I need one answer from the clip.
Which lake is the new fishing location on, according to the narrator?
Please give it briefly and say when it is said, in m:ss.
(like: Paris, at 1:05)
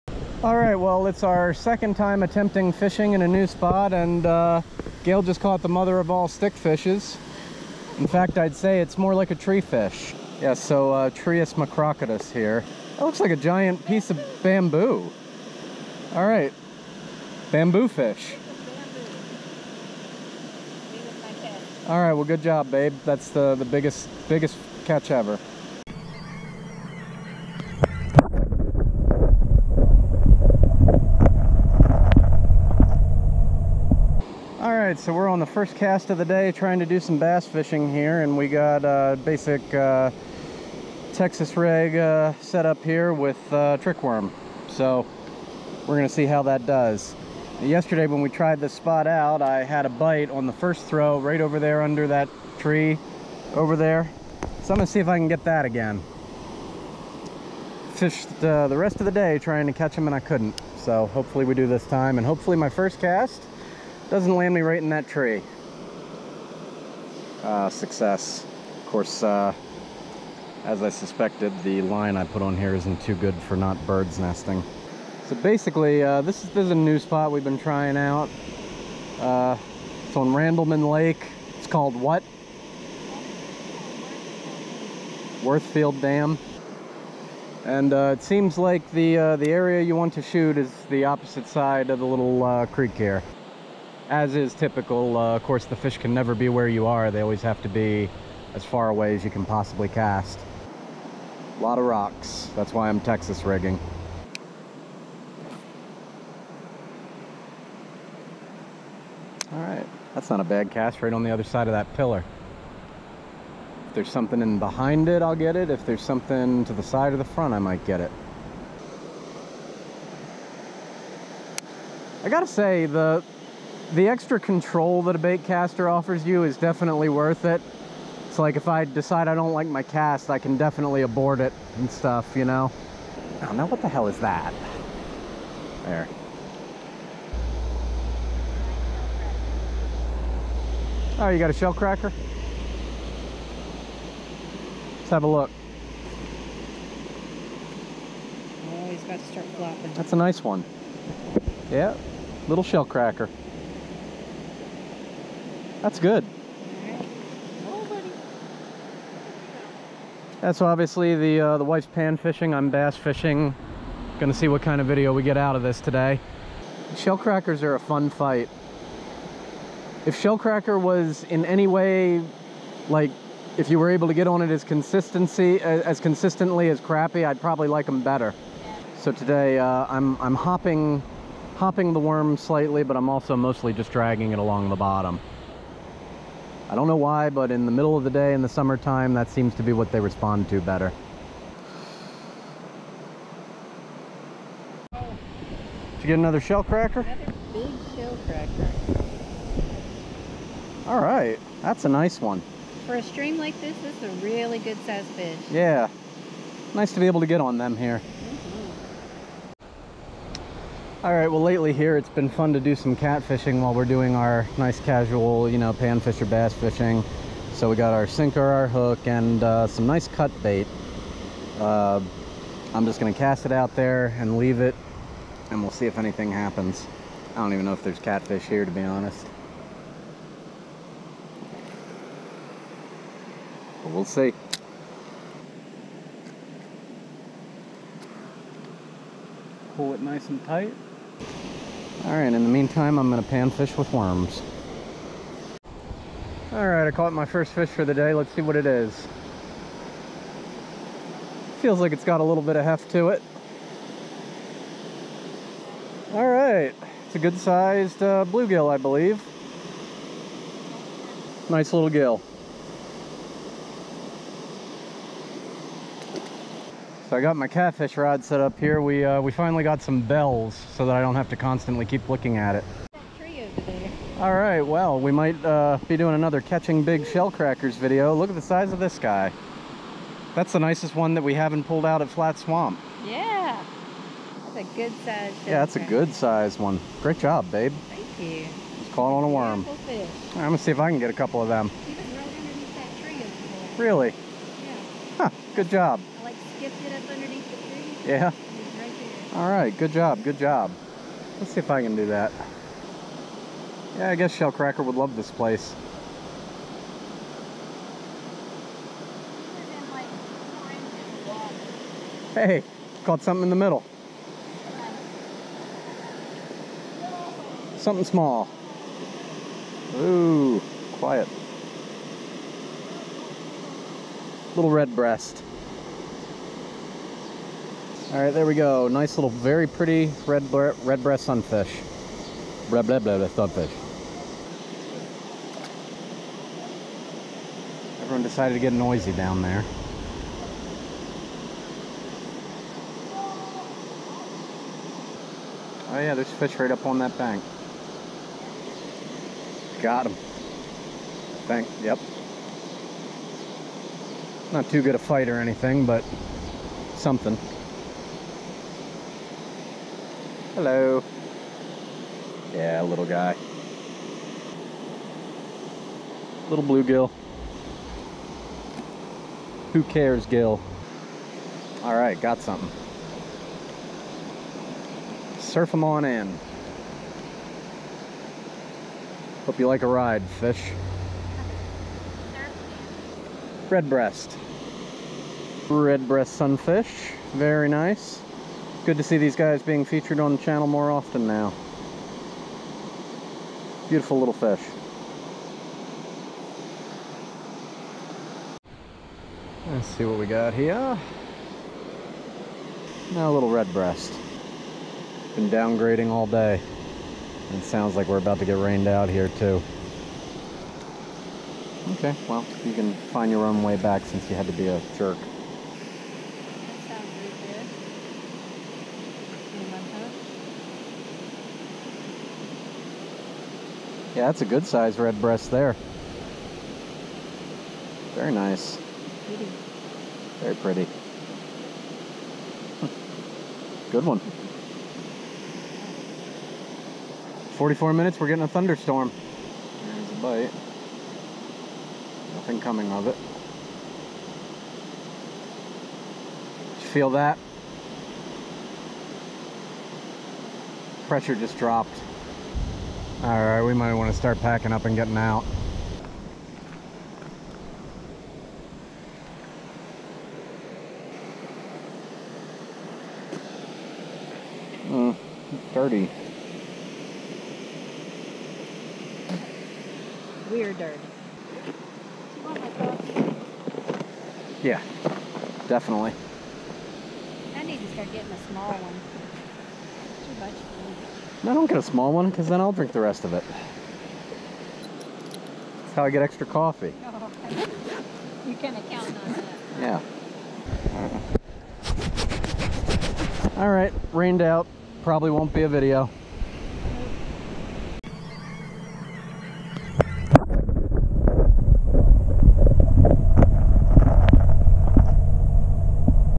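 Randleman Lake, at 1:20.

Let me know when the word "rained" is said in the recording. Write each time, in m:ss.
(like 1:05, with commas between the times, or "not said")
6:48, 8:14.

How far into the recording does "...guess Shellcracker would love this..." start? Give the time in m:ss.
5:04.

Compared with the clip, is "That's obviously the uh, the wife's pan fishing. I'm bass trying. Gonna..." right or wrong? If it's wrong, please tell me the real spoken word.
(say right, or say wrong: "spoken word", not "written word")
wrong: "fishing", not "trying".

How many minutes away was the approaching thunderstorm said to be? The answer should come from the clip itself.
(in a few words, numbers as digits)
44.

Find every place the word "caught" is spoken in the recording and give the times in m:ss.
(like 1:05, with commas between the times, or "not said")
0:05, 4:06, 4:48, 5:13.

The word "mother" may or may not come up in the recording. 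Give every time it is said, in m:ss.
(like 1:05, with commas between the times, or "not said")
0:05.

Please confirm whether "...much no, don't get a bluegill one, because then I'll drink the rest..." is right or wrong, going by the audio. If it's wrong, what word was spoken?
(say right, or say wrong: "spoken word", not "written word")
wrong: "small", not "bluegill".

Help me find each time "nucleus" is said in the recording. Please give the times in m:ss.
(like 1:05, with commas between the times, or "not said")
not said.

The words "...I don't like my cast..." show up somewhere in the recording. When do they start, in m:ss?
2:09.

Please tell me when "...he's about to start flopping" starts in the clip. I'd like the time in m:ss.
2:28.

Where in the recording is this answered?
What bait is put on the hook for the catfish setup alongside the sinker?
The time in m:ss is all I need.
3:40.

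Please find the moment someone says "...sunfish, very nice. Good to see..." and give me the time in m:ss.
6:26.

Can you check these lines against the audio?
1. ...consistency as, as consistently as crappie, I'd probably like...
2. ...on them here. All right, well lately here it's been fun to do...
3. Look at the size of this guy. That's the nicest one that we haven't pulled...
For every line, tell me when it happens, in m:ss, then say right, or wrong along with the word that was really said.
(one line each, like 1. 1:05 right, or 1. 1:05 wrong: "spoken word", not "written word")
1. 2:54 right
2. 3:27 right
3. 4:38 right.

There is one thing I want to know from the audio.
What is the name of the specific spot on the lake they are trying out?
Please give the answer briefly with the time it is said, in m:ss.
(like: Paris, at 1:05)
Worthfield Dam, at 1:25.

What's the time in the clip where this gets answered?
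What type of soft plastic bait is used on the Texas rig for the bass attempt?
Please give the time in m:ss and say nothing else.
0:43.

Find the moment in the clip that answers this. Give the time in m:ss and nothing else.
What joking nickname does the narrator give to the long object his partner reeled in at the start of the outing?
0:17.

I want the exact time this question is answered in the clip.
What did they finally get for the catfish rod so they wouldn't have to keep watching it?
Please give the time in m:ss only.
4:29.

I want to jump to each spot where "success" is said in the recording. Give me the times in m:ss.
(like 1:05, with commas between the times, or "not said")
1:07.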